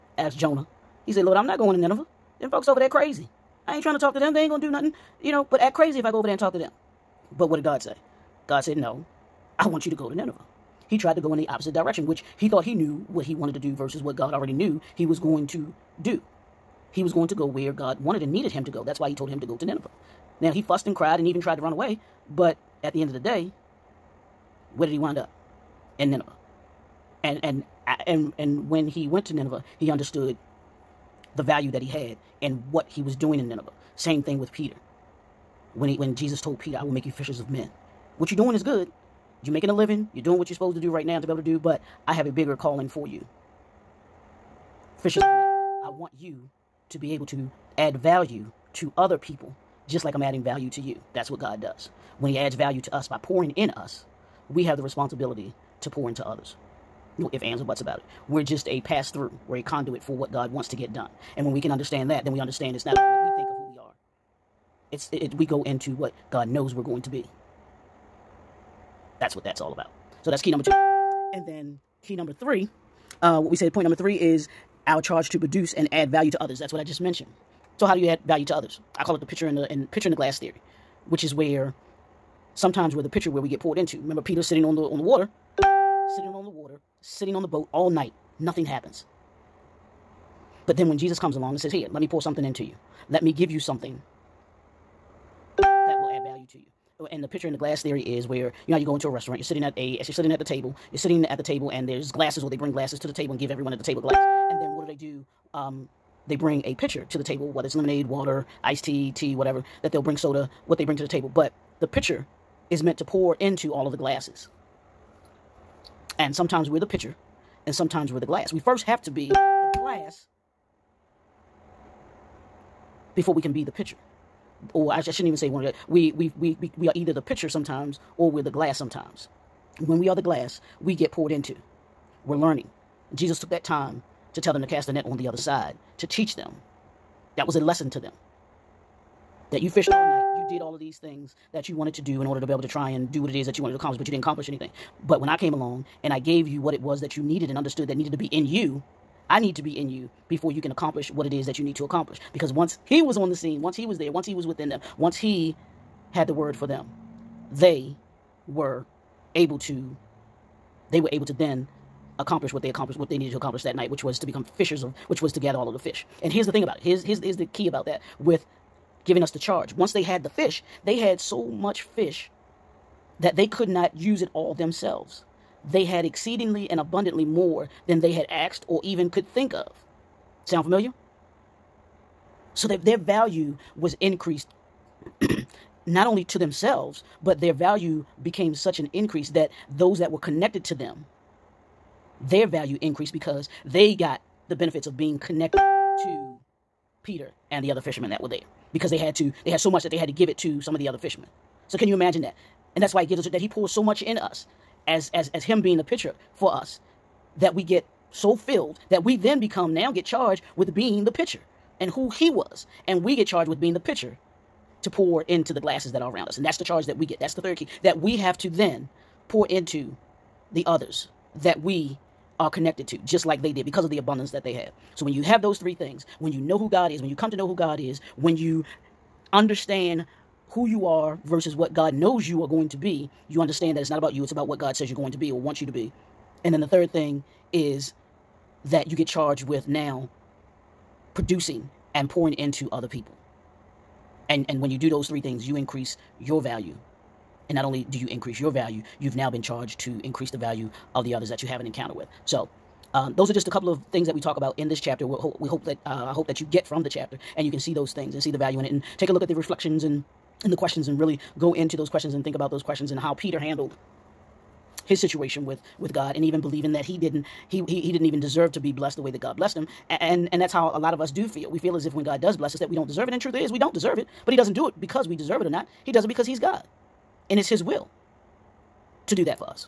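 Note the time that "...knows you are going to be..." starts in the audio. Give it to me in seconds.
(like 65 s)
231 s.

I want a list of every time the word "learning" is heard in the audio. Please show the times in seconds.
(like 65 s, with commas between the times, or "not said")
132 s.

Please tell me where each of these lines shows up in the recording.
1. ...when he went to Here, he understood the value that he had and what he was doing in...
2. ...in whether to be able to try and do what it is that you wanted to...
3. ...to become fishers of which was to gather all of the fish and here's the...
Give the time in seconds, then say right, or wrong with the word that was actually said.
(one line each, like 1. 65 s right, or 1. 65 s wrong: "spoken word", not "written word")
1. 28 s wrong: "Nineveh", not "Here"
2. 142 s wrong: "order", not "whether"
3. 164 s right.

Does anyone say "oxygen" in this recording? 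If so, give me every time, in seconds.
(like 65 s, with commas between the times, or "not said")
not said.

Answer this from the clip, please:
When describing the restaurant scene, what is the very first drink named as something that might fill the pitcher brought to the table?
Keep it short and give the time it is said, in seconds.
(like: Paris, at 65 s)
lemonade, at 107 s.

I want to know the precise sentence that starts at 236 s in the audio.
And then the third thing is that you get charged with now producing and pouring into other people.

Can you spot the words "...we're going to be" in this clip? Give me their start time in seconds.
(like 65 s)
66 s.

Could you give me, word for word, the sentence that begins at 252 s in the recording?
So um, those are just a couple of things that we talk about in this chapter.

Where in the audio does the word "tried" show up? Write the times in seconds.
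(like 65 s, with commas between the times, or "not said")
10 s, 21 s.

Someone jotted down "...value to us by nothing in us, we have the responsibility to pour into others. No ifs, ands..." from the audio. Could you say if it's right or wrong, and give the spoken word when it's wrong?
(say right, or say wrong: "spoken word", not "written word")
wrong: "pouring", not "nothing".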